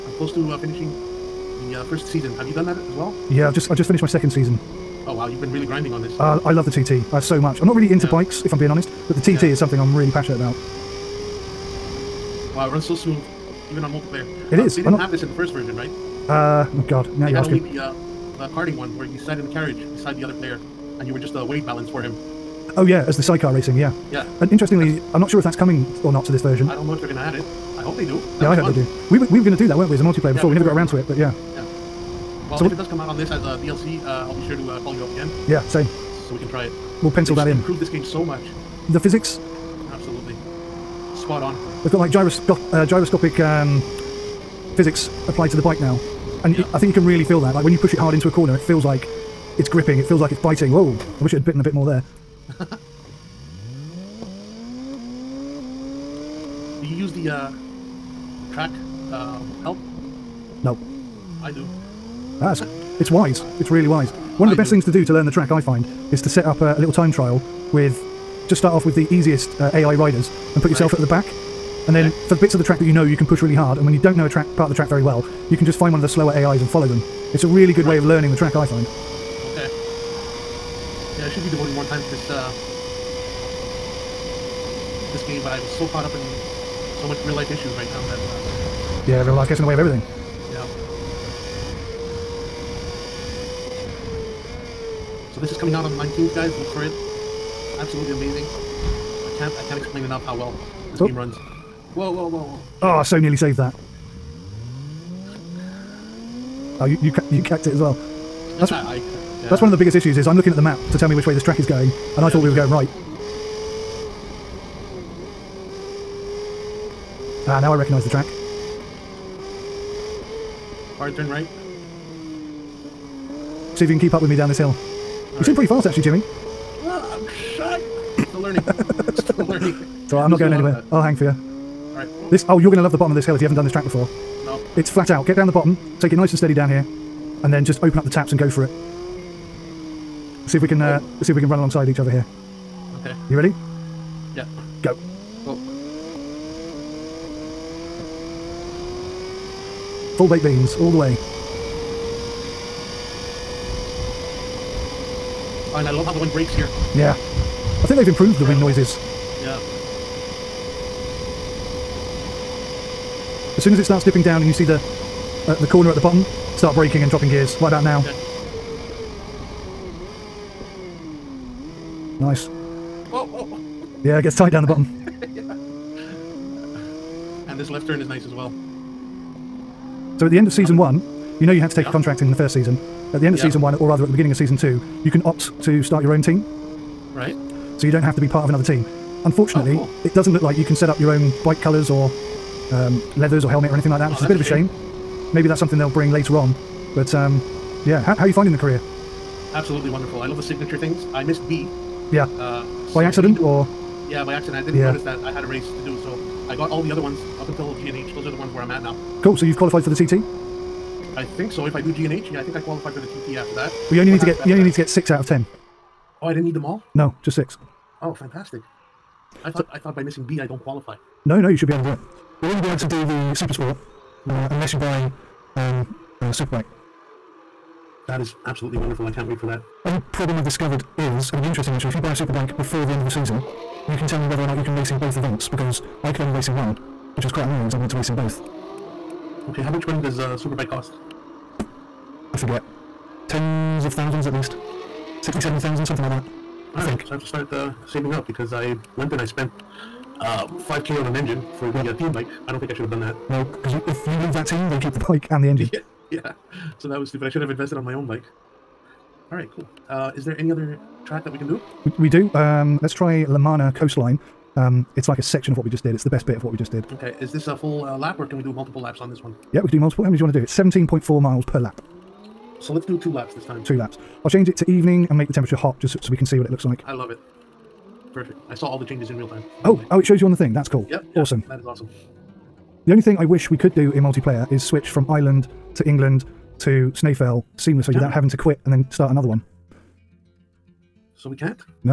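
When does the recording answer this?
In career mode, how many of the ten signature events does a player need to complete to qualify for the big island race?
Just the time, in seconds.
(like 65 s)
214 s.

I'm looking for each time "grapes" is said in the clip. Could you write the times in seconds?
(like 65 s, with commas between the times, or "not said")
not said.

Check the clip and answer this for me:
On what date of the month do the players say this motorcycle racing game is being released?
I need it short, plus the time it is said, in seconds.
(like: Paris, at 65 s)
19th, at 95 s.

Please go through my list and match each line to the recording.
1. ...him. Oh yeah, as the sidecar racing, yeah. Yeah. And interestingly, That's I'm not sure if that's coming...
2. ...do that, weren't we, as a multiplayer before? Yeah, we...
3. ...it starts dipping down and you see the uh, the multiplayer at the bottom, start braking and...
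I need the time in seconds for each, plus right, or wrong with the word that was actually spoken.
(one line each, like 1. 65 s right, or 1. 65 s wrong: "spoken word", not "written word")
1. 22 s right
2. 29 s right
3. 163 s wrong: "corner", not "multiplayer".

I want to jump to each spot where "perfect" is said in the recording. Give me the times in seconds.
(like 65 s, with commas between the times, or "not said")
222 s, 278 s.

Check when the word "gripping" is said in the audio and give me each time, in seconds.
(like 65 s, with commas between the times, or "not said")
49 s.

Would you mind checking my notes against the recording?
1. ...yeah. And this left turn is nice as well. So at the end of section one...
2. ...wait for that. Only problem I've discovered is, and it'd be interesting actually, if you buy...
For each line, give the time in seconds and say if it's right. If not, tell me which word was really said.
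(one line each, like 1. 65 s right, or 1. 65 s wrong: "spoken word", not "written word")
1. 175 s wrong: "season", not "section"
2. 229 s right.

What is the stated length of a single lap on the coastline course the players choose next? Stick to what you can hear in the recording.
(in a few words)
17.4 miles.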